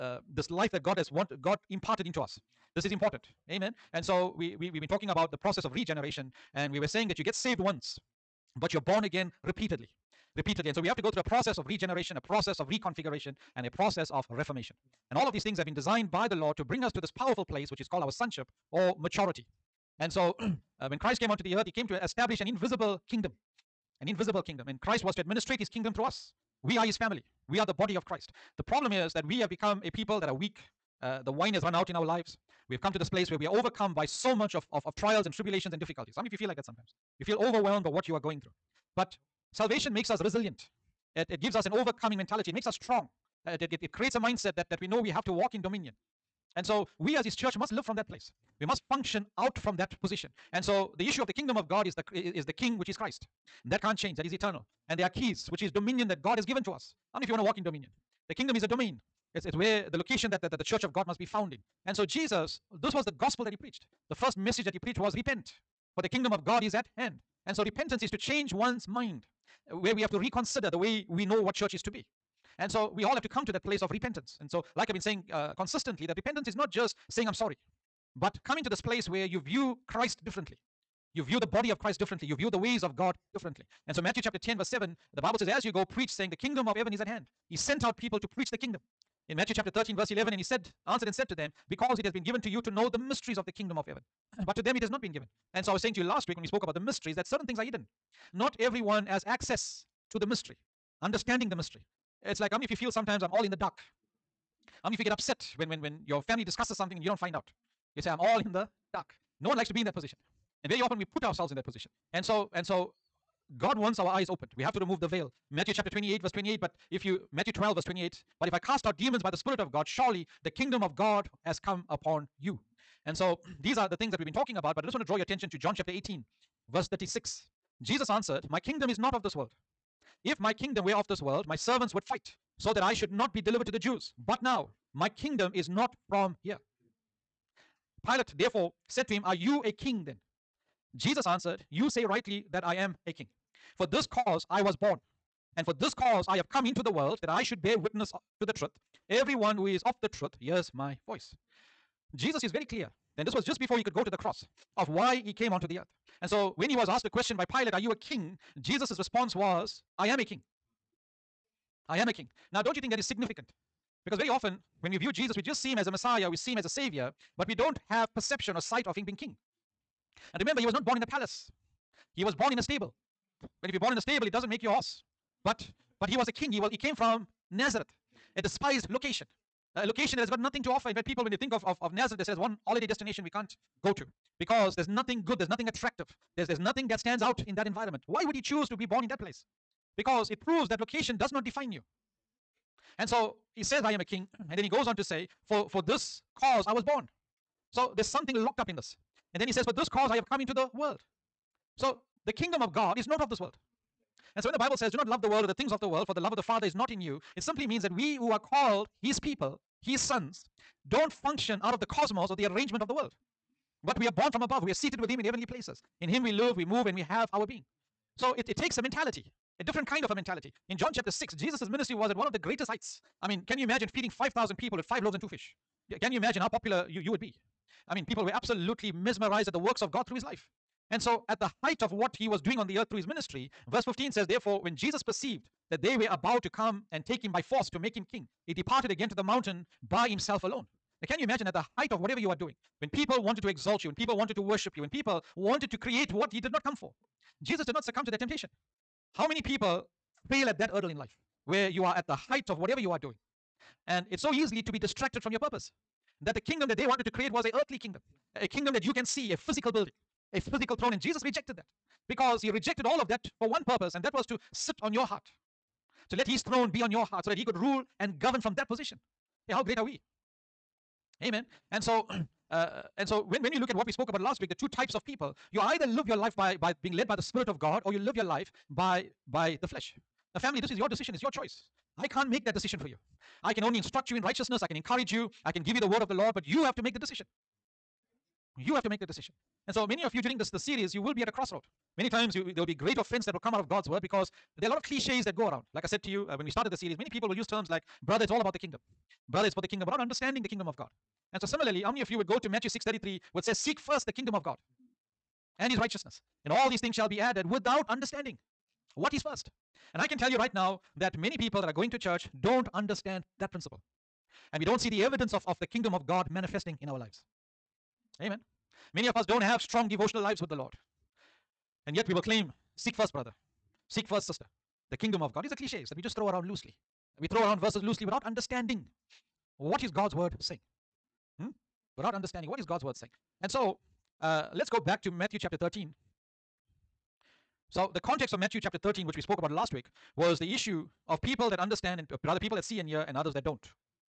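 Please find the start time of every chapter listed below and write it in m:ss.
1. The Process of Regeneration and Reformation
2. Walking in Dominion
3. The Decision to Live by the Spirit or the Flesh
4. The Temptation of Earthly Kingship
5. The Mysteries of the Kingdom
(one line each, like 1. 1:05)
1. 0:10
2. 0:54
3. 4:38
4. 3:52
5. 1:36.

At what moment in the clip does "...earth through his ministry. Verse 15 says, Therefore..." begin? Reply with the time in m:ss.
3:52.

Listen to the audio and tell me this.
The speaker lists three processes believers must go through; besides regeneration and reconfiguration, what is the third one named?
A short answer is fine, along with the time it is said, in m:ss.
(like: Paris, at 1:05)
reformation, at 0:14.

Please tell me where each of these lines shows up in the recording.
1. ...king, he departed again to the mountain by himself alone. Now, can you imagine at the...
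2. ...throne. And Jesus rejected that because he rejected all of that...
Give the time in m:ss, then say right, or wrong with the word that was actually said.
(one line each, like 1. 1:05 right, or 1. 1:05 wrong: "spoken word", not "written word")
1. 3:58 right
2. 4:20 right.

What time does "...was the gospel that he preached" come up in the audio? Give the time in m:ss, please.
1:02.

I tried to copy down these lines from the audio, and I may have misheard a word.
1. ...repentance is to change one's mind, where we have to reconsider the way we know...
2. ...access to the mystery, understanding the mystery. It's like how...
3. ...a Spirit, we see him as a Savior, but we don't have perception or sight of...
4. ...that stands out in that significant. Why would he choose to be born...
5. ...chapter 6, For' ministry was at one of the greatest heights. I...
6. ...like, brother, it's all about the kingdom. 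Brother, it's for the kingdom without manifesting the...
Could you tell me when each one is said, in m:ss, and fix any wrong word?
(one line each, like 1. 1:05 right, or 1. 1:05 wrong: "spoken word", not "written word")
1. 1:07 right
2. 1:39 right
3. 2:45 wrong: "Messiah", not "Spirit"
4. 3:06 wrong: "environment", not "significant"
5. 3:40 wrong: "Jesus", not "For"
6. 4:57 wrong: "understanding", not "manifesting".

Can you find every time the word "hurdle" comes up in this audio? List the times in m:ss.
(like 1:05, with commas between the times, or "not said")
4:10.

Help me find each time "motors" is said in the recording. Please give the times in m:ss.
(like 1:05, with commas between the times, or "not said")
not said.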